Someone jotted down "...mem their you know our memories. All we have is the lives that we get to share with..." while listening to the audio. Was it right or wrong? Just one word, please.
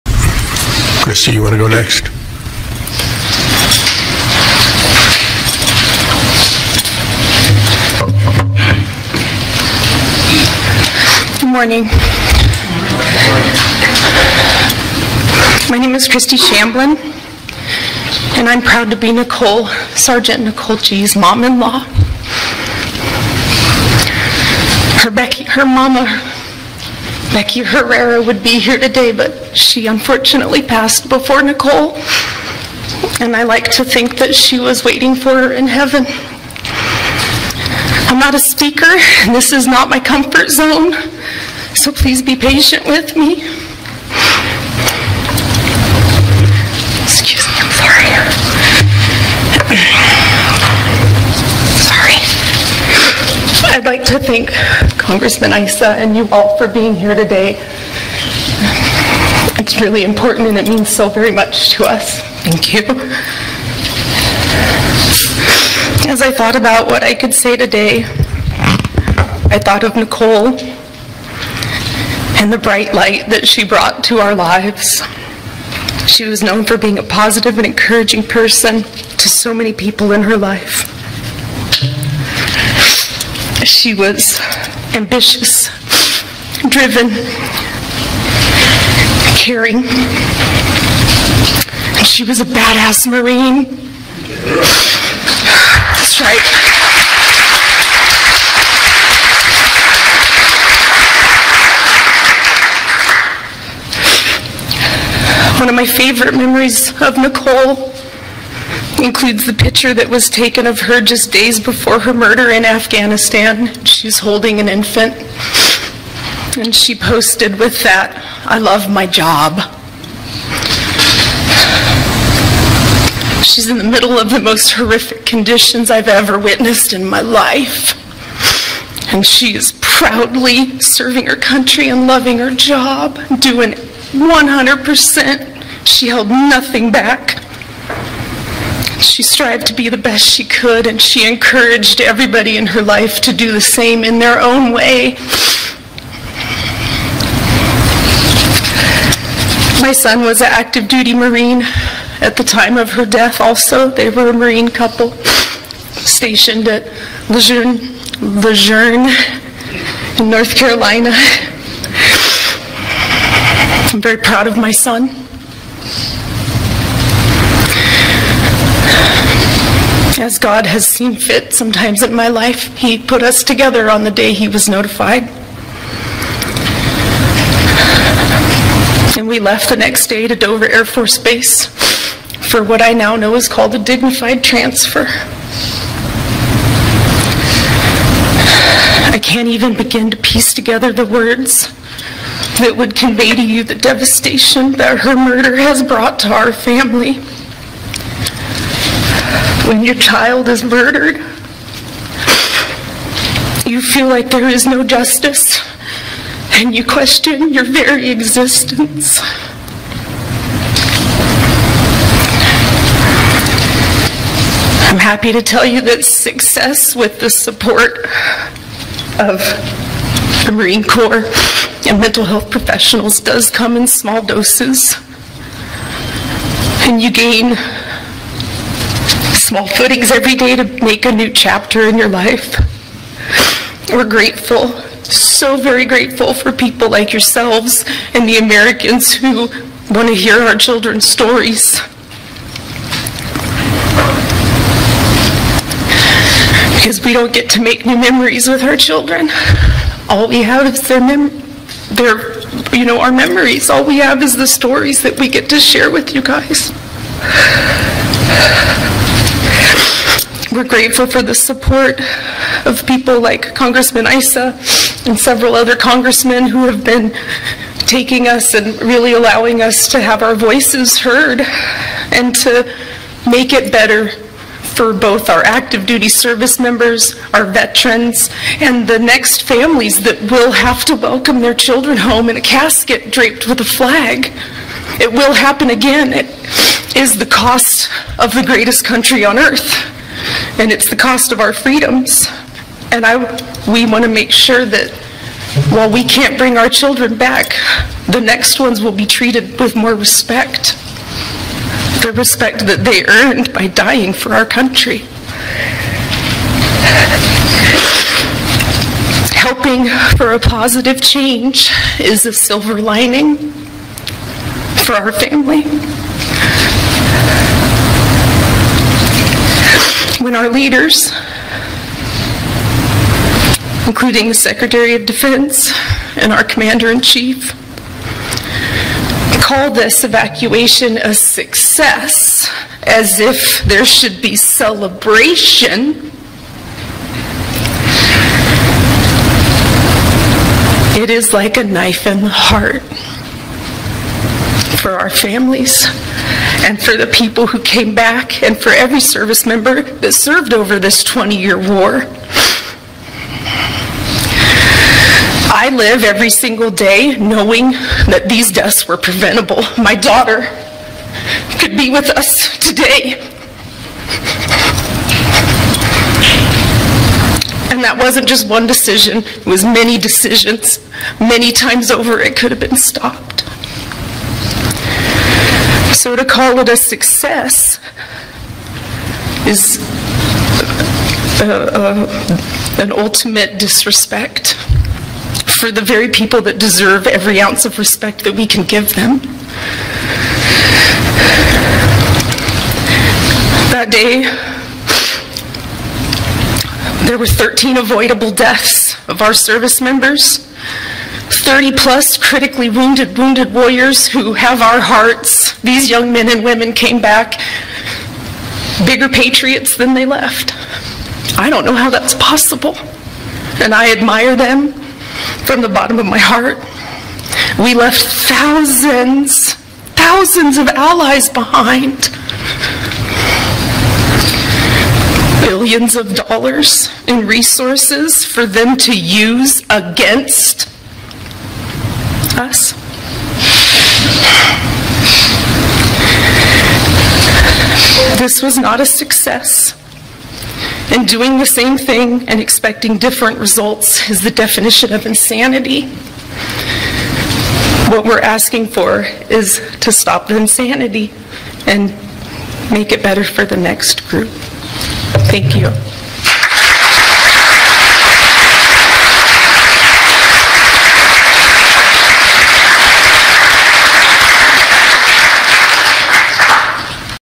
wrong.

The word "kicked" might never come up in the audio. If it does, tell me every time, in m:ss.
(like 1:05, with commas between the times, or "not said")
not said.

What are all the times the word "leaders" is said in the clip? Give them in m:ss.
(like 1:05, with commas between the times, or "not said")
5:20.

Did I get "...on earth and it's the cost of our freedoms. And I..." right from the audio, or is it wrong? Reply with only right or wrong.
right.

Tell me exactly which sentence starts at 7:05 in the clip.
Billions of dollars in resources for them to use against us?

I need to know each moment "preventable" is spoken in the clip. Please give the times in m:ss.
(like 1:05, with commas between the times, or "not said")
5:58.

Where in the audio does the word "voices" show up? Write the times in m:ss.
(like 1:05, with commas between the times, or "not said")
4:30.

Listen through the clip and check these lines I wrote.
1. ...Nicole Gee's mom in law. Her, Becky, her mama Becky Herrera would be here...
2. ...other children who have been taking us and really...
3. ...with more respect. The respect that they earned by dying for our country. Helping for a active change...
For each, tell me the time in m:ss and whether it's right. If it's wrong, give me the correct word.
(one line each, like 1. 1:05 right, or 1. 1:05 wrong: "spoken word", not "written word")
1. 0:20 right
2. 4:25 wrong: "congressmen", not "children"
3. 4:59 wrong: "positive", not "active".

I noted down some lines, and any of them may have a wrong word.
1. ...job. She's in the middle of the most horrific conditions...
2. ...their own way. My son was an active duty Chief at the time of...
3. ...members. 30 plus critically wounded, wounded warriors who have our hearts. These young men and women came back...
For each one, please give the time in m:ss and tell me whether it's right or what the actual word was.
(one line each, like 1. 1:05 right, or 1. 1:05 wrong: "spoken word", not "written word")
1. 1:59 right
2. 2:24 wrong: "Marine", not "Chief"
3. 6:39 right.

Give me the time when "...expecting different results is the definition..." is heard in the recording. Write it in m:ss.
7:22.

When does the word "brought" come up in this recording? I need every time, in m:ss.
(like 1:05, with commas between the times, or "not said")
1:13, 3:15.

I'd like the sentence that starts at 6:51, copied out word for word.
I don't know how that's possible.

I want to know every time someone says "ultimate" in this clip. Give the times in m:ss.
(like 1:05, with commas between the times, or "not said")
6:22.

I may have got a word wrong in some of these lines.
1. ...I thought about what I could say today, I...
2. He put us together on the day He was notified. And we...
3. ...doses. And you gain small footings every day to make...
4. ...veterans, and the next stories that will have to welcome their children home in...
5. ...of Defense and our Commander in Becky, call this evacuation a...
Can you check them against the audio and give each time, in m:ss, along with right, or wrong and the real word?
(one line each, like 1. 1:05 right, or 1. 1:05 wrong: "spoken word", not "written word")
1. 1:06 right
2. 2:52 right
3. 3:44 right
4. 4:37 wrong: "families", not "stories"
5. 5:24 wrong: "Chief", not "Becky".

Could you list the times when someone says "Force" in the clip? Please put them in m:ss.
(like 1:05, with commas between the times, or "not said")
3:00.